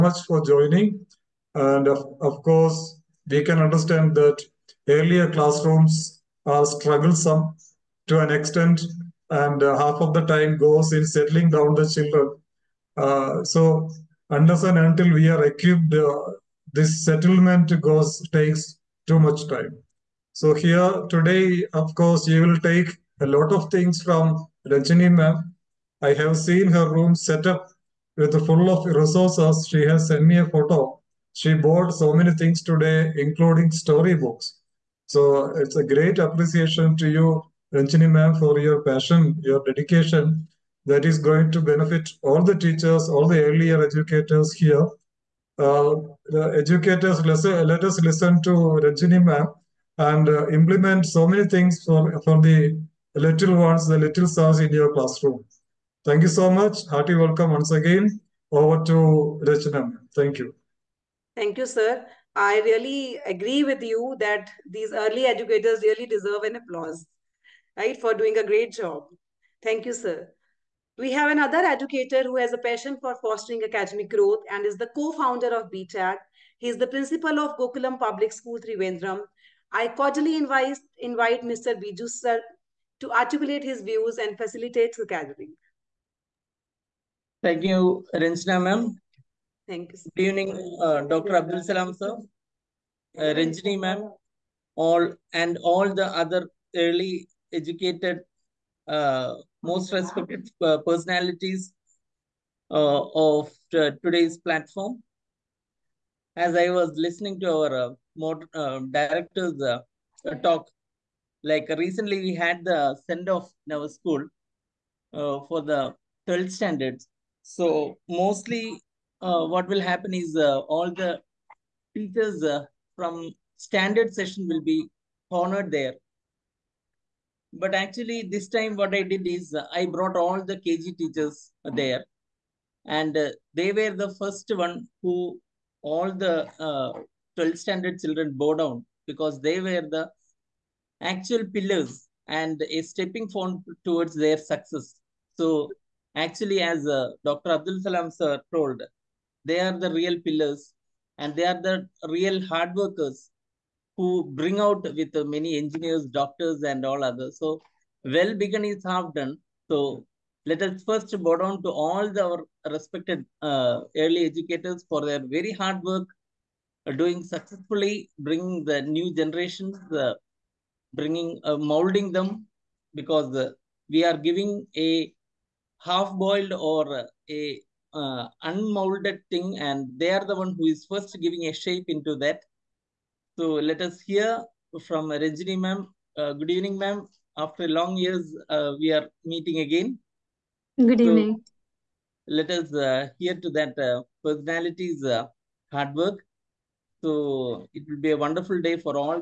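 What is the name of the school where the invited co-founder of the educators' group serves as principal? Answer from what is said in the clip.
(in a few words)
Gokulam Public School.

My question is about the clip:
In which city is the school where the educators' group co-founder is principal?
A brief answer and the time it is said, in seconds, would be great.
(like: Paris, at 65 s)
Trivandrum, at 78 s.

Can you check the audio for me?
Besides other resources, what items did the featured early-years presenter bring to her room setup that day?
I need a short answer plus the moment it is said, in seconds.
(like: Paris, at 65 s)
storybooks, at 33 s.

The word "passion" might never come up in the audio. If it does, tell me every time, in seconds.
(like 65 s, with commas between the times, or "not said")
38 s, 72 s.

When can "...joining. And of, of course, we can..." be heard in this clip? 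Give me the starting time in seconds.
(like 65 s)
0 s.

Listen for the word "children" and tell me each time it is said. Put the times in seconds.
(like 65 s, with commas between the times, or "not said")
11 s, 137 s.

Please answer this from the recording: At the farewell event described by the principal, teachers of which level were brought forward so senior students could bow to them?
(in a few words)
KG.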